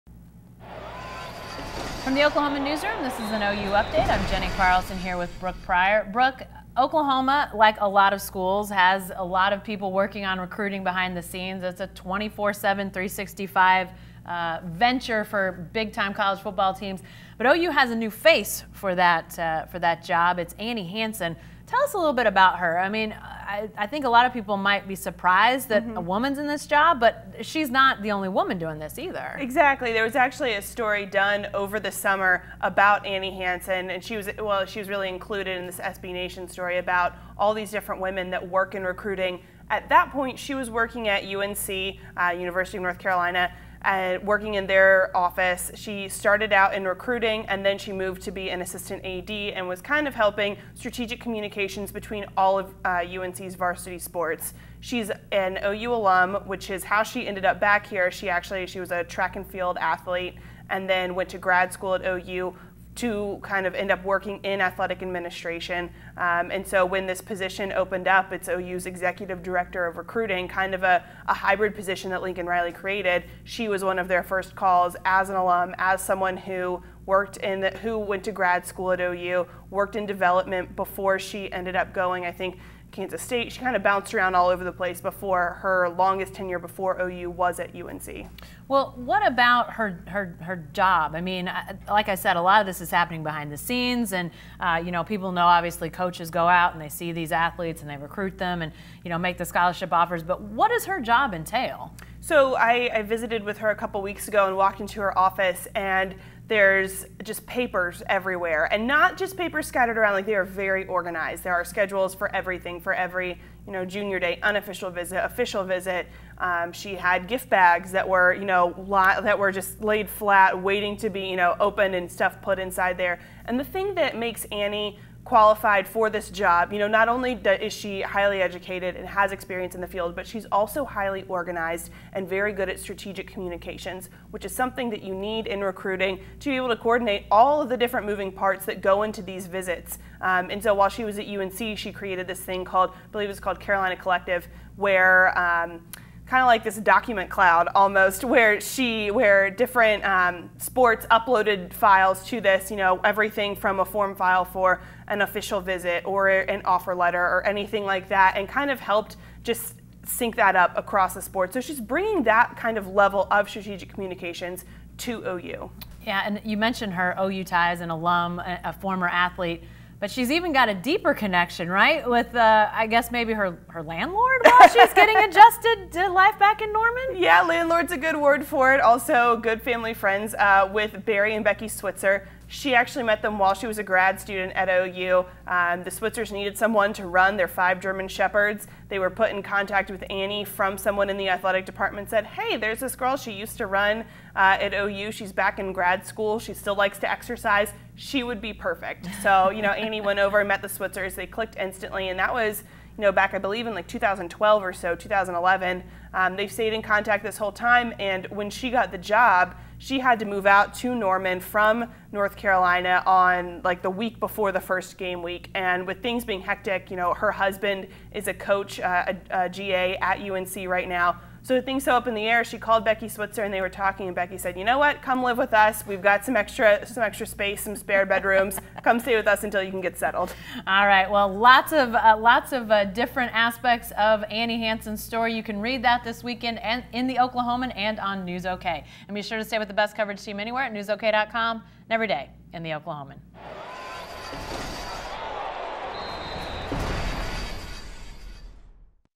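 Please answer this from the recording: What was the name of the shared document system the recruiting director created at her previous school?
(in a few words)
Carolina Collective.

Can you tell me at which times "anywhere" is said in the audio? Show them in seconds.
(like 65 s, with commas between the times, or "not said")
240 s.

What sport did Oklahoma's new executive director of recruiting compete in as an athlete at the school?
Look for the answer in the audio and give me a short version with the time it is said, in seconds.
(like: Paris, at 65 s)
Track and field, at 59 s.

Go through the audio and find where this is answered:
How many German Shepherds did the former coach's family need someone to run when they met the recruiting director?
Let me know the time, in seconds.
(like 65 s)
187 s.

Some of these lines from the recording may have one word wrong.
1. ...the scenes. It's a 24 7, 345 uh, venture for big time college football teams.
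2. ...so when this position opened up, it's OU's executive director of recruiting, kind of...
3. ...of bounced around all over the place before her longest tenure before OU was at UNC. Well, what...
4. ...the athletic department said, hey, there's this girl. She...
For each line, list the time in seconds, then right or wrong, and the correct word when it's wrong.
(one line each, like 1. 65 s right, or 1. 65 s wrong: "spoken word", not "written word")
1. 11 s wrong: "365", not "345"
2. 66 s right
3. 83 s right
4. 191 s right.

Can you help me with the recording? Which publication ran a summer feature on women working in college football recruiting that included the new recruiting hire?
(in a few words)
SB Nation.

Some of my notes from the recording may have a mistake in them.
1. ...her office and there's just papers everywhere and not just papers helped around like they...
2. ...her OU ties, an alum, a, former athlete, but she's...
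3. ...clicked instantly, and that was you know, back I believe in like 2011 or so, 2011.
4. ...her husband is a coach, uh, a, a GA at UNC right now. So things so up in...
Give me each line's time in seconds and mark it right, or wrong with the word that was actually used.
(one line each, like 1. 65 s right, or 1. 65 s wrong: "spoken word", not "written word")
1. 105 s wrong: "scattered", not "helped"
2. 166 s right
3. 201 s wrong: "2012", not "2011"
4. 217 s right.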